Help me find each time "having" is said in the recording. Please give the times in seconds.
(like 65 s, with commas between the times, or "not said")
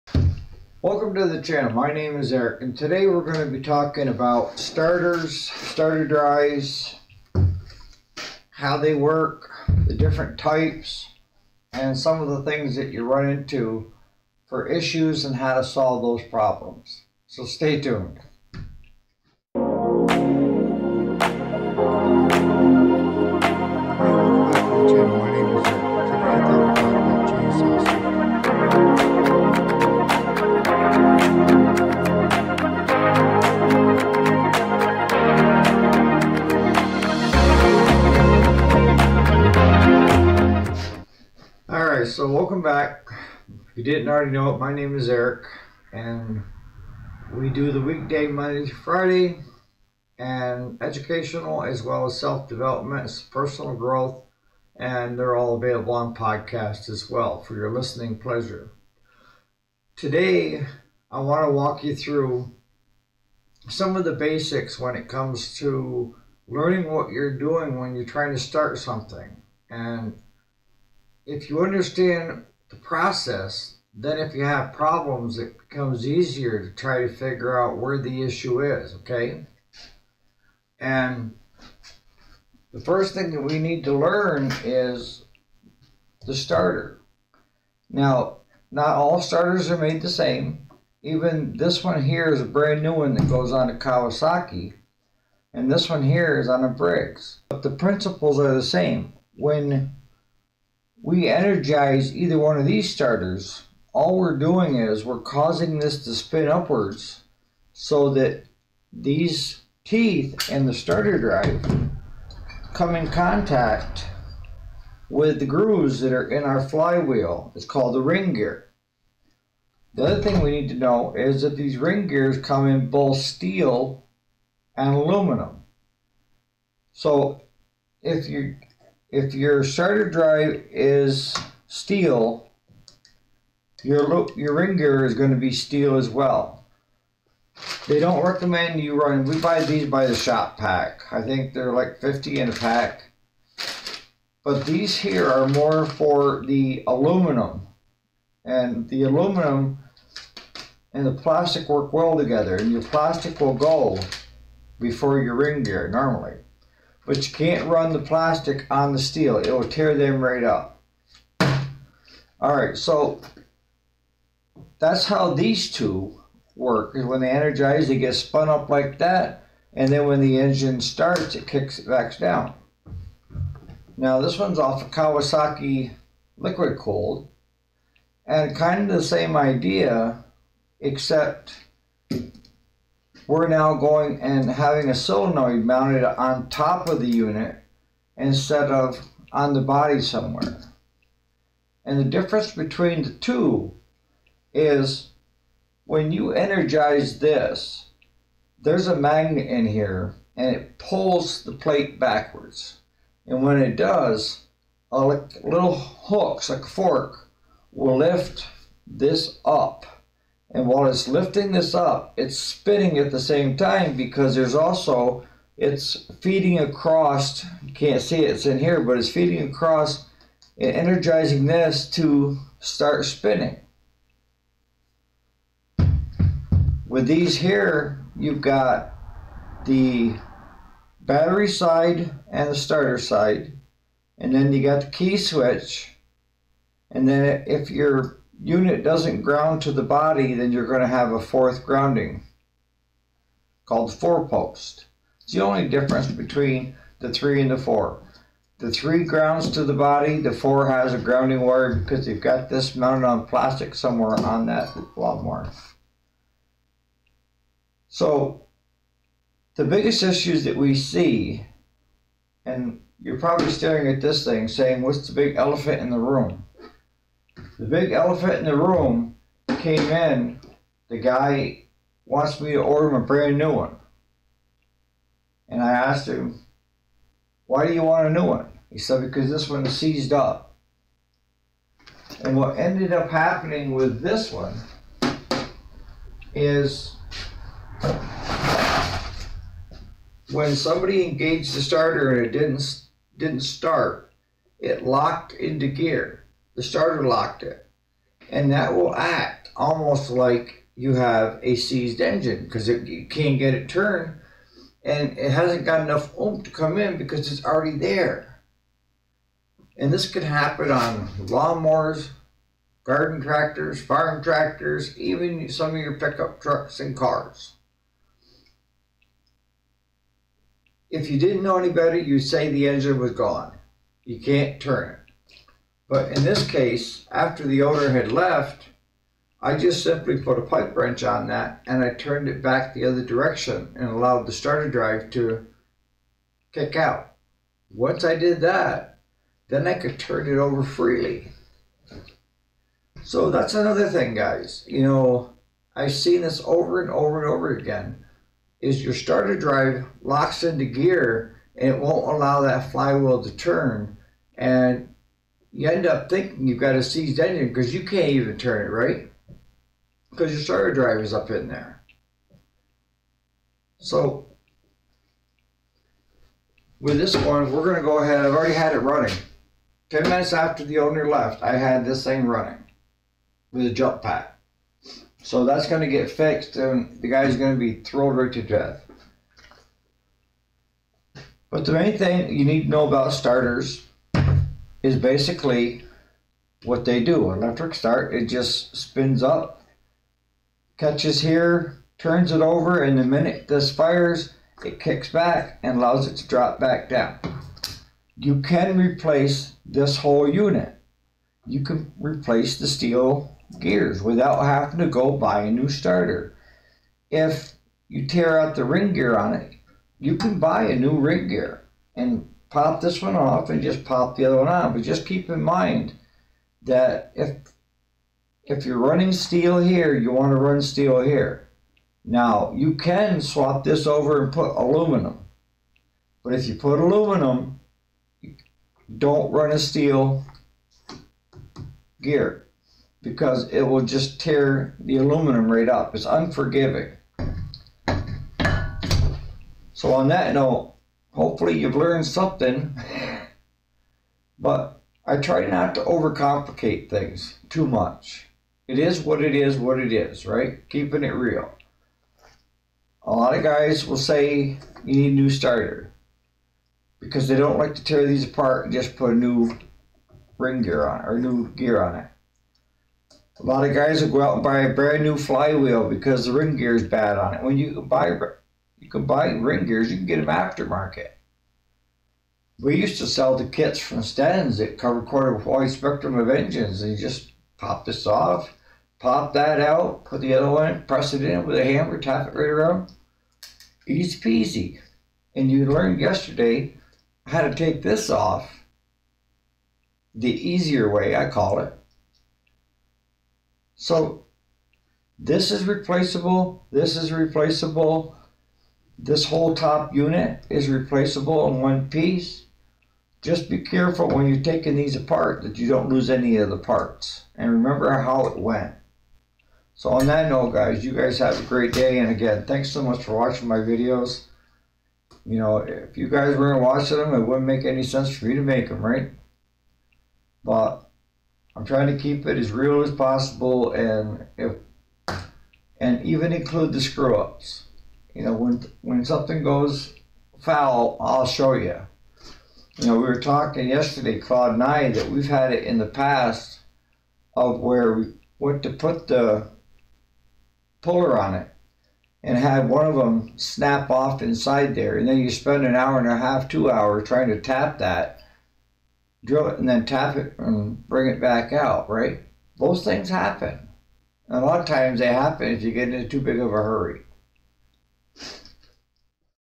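184 s, 404 s.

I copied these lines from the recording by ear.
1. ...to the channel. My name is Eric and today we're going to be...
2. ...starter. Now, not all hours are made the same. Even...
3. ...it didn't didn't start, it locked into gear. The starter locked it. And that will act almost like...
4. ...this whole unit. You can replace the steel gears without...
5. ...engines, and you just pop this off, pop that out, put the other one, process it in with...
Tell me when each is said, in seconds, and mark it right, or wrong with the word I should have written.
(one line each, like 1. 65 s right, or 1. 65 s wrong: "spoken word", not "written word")
1. 1 s right
2. 86 s wrong: "starters", not "hours"
3. 292 s right
4. 399 s right
5. 476 s wrong: "press", not "process".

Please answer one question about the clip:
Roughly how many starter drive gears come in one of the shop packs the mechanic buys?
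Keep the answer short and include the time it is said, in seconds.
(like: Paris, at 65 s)
50, at 141 s.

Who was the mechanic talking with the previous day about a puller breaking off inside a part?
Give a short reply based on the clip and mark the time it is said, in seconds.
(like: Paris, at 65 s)
Claude, at 534 s.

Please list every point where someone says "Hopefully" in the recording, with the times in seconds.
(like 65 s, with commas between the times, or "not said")
441 s.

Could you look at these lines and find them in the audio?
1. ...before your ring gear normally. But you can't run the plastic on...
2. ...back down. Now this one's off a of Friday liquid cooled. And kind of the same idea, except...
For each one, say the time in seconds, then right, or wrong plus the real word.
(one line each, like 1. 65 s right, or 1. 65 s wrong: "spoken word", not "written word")
1. 154 s right
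2. 171 s wrong: "Kawasaki", not "Friday".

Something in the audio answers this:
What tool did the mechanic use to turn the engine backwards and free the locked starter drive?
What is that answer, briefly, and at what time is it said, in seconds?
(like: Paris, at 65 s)
Pipe wrench, at 330 s.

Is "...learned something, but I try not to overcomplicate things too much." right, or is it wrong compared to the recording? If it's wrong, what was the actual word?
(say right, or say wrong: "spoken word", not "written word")
right.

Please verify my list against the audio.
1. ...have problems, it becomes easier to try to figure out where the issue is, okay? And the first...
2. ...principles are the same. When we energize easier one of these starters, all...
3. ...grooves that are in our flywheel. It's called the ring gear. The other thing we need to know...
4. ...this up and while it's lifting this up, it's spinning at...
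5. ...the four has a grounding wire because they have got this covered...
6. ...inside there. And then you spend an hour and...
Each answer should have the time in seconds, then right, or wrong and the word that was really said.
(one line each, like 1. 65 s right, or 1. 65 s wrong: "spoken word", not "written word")
1. 74 s right
2. 97 s wrong: "either", not "easier"
3. 115 s right
4. 208 s right
5. 250 s wrong: "mounted", not "covered"
6. 544 s right.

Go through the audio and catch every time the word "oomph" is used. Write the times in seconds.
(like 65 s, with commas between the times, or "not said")
306 s.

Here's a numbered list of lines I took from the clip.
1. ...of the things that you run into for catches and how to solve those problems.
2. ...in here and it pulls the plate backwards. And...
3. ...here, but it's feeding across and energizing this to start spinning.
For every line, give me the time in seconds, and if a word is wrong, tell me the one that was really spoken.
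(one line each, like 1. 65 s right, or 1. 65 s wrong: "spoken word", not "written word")
1. 12 s wrong: "issues", not "catches"
2. 199 s right
3. 218 s right.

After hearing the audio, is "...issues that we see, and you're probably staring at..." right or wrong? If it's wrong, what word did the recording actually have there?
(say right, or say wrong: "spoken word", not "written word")
right.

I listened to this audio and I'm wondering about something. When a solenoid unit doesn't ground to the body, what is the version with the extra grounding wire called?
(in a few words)
Four post.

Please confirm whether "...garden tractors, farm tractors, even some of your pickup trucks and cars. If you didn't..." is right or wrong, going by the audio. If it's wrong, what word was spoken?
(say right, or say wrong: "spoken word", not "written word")
right.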